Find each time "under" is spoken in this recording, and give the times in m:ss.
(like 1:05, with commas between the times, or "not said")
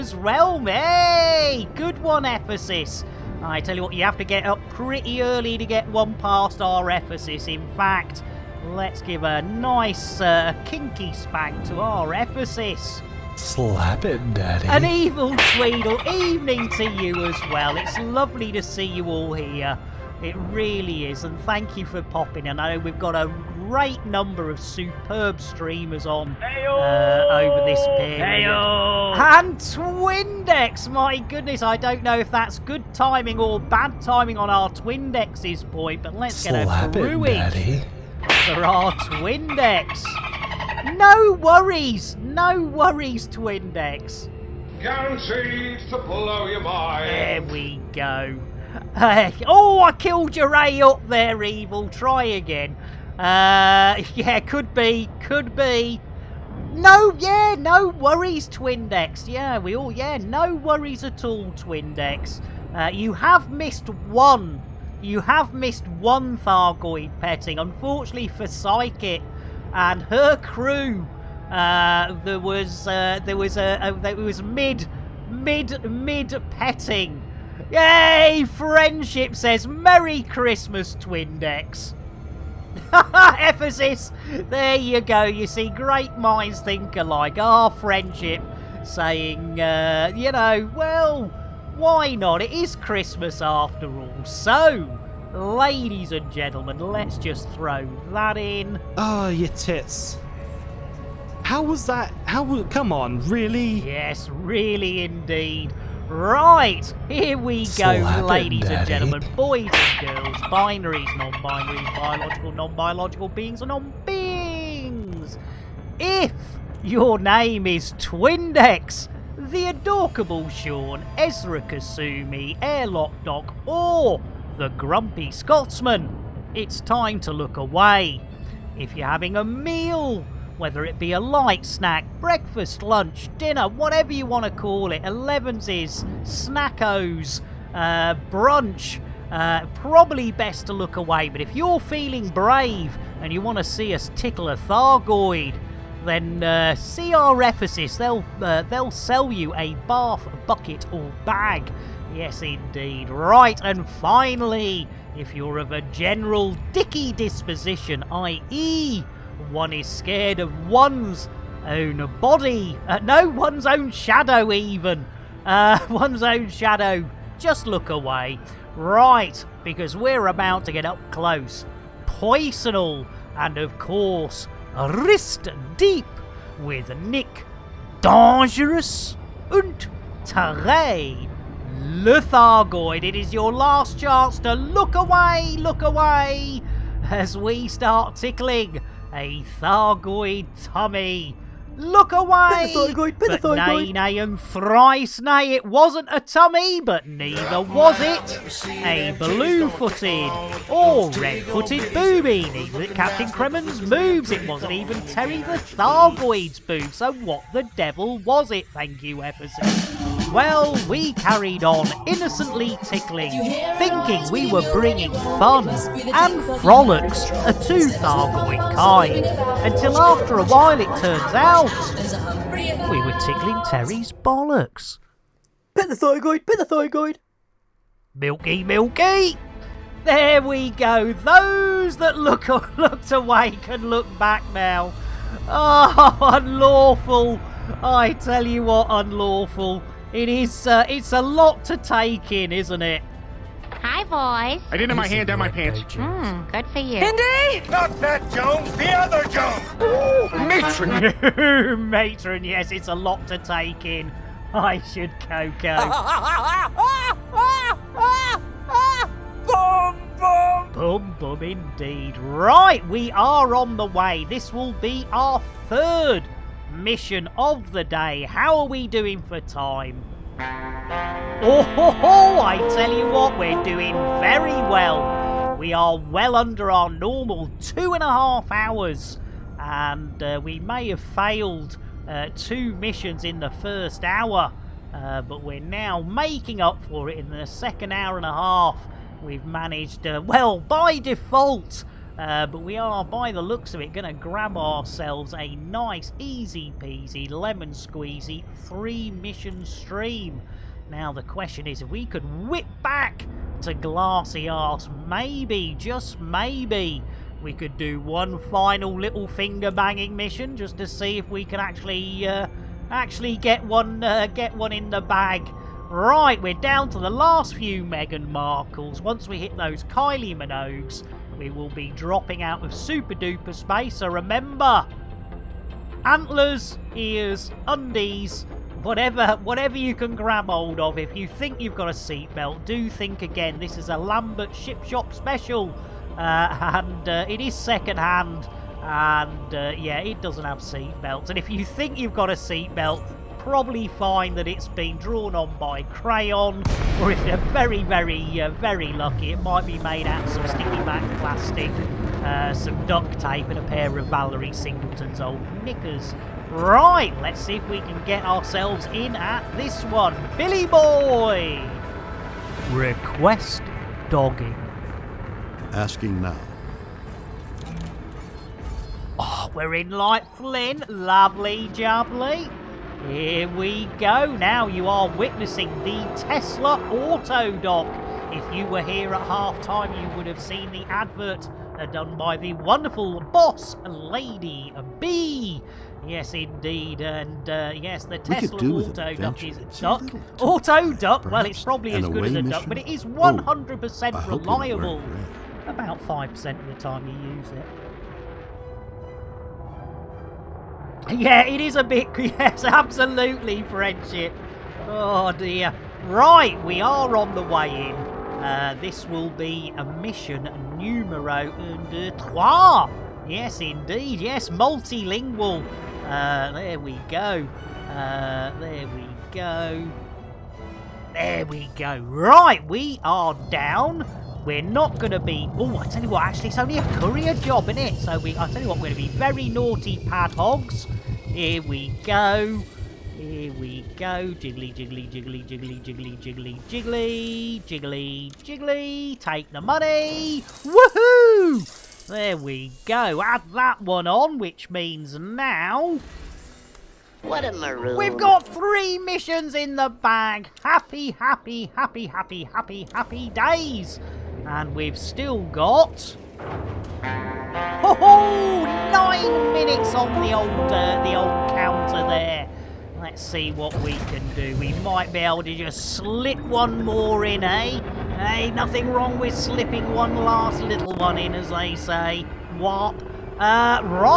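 4:36, 6:51.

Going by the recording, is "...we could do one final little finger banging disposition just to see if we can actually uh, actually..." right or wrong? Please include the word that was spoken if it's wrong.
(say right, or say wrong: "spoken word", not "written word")
wrong: "mission", not "disposition".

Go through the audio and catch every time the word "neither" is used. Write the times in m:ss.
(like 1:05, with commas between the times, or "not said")
3:17, 3:22.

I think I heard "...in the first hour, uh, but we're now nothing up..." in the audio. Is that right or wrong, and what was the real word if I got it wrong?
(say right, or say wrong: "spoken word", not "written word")
wrong: "making", not "nothing".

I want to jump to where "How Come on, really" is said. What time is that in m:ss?
1:42.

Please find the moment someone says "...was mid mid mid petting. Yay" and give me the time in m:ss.
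1:14.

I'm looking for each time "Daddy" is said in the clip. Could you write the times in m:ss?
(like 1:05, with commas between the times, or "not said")
0:14.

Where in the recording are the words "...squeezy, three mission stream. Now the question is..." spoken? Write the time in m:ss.
4:57.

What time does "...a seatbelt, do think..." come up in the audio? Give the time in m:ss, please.
5:31.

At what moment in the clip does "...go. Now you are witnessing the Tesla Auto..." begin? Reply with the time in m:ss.
6:13.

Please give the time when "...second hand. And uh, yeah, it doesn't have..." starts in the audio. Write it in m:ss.
5:37.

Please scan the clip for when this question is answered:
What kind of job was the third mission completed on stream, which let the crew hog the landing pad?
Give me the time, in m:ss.
7:06.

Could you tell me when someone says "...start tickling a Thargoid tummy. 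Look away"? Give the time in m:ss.
3:07.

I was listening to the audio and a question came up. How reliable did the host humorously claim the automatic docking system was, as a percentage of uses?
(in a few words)
5 percent.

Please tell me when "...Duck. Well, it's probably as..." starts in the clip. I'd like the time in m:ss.
6:30.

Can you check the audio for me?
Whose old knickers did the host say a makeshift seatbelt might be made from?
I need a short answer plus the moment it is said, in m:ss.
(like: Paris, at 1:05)
Valerie Singleton, at 5:54.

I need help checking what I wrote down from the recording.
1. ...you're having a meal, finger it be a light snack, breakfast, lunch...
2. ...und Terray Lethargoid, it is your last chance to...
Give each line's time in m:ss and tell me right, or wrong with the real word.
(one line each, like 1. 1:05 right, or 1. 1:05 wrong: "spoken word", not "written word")
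1. 2:08 wrong: "whether", not "finger"
2. 2:59 right.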